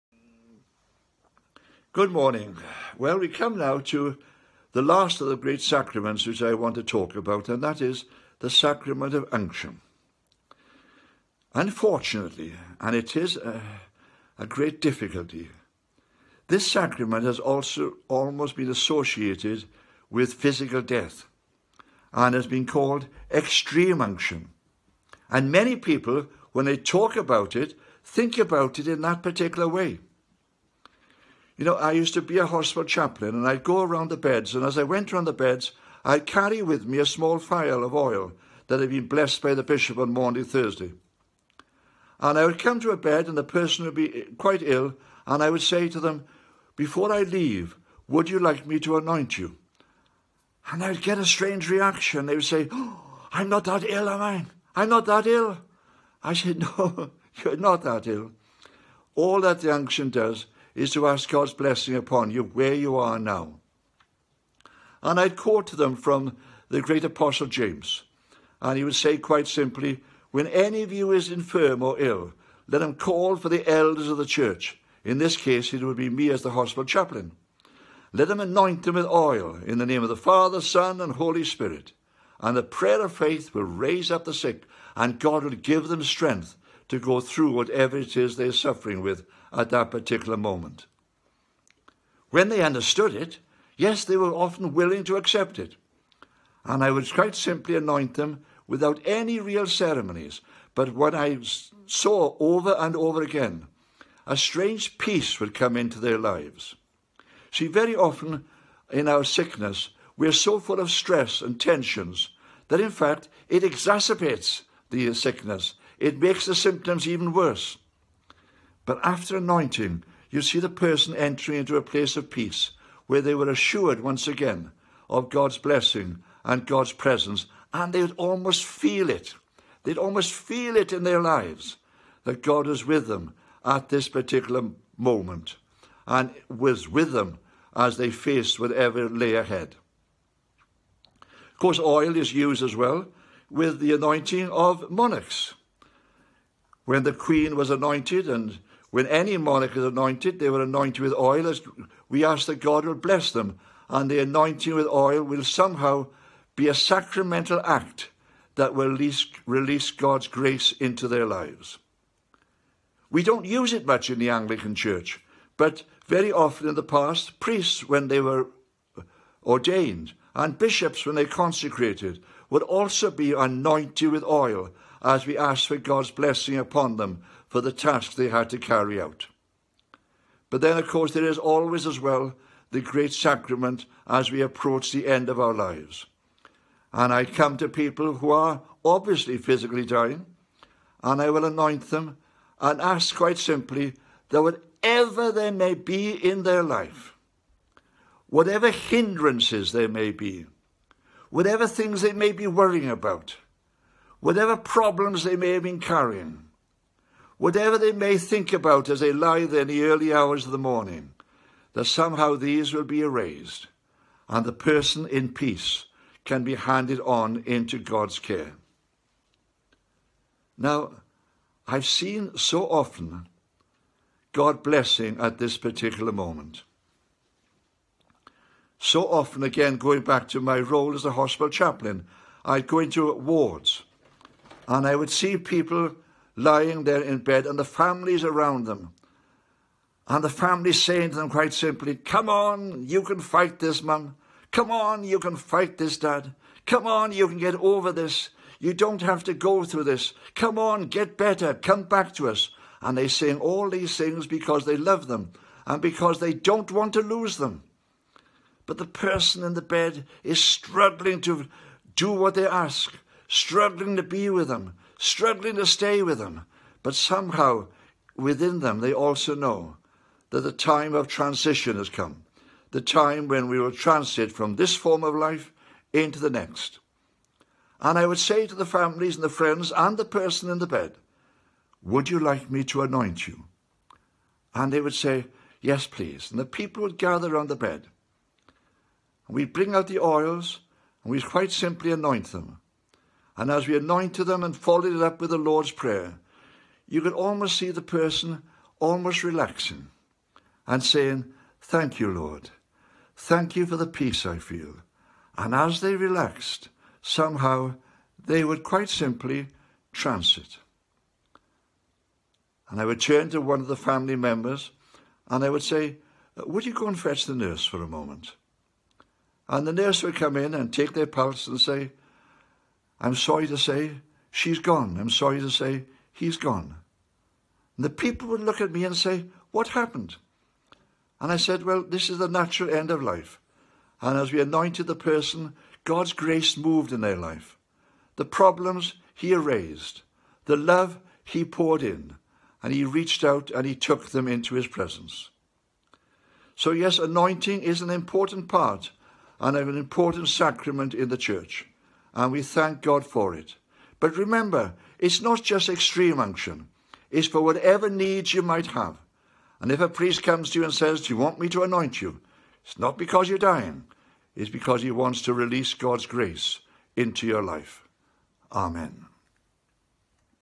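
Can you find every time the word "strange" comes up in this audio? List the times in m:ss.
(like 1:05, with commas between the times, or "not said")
0:51, 1:44.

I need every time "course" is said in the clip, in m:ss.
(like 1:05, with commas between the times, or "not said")
2:21, 3:00.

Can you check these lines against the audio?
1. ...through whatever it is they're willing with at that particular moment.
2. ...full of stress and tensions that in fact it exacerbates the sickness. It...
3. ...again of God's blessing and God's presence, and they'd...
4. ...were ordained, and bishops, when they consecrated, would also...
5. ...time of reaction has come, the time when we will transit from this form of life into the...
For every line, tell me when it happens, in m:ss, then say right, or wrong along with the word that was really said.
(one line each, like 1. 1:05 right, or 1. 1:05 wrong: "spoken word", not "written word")
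1. 1:27 wrong: "suffering", not "willing"
2. 1:50 right
3. 2:04 right
4. 2:48 right
5. 4:30 wrong: "transition", not "reaction".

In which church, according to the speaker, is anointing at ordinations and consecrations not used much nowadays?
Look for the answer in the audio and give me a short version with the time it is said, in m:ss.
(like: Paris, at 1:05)
Anglican Church, at 2:44.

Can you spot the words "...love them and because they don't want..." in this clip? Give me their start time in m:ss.
4:14.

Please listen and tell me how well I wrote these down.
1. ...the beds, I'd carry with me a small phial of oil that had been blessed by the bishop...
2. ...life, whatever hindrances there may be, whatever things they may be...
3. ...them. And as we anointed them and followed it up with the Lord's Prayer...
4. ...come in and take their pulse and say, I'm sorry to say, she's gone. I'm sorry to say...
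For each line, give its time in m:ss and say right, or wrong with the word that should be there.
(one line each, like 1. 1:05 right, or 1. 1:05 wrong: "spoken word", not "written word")
1. 0:35 right
2. 3:16 right
3. 4:52 right
4. 5:20 right.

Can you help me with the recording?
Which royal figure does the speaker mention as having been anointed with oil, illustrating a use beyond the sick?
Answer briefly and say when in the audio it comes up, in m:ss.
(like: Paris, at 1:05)
The queen, at 2:27.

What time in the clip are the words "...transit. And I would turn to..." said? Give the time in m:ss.
5:09.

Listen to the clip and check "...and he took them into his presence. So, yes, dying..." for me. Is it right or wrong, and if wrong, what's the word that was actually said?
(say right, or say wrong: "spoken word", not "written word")
wrong: "anointing", not "dying".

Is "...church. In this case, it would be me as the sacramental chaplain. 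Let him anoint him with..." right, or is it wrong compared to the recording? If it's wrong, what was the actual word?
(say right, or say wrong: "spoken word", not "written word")
wrong: "hospital", not "sacramental".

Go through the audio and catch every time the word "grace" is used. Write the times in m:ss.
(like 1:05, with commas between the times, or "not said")
2:40, 5:36, 6:06.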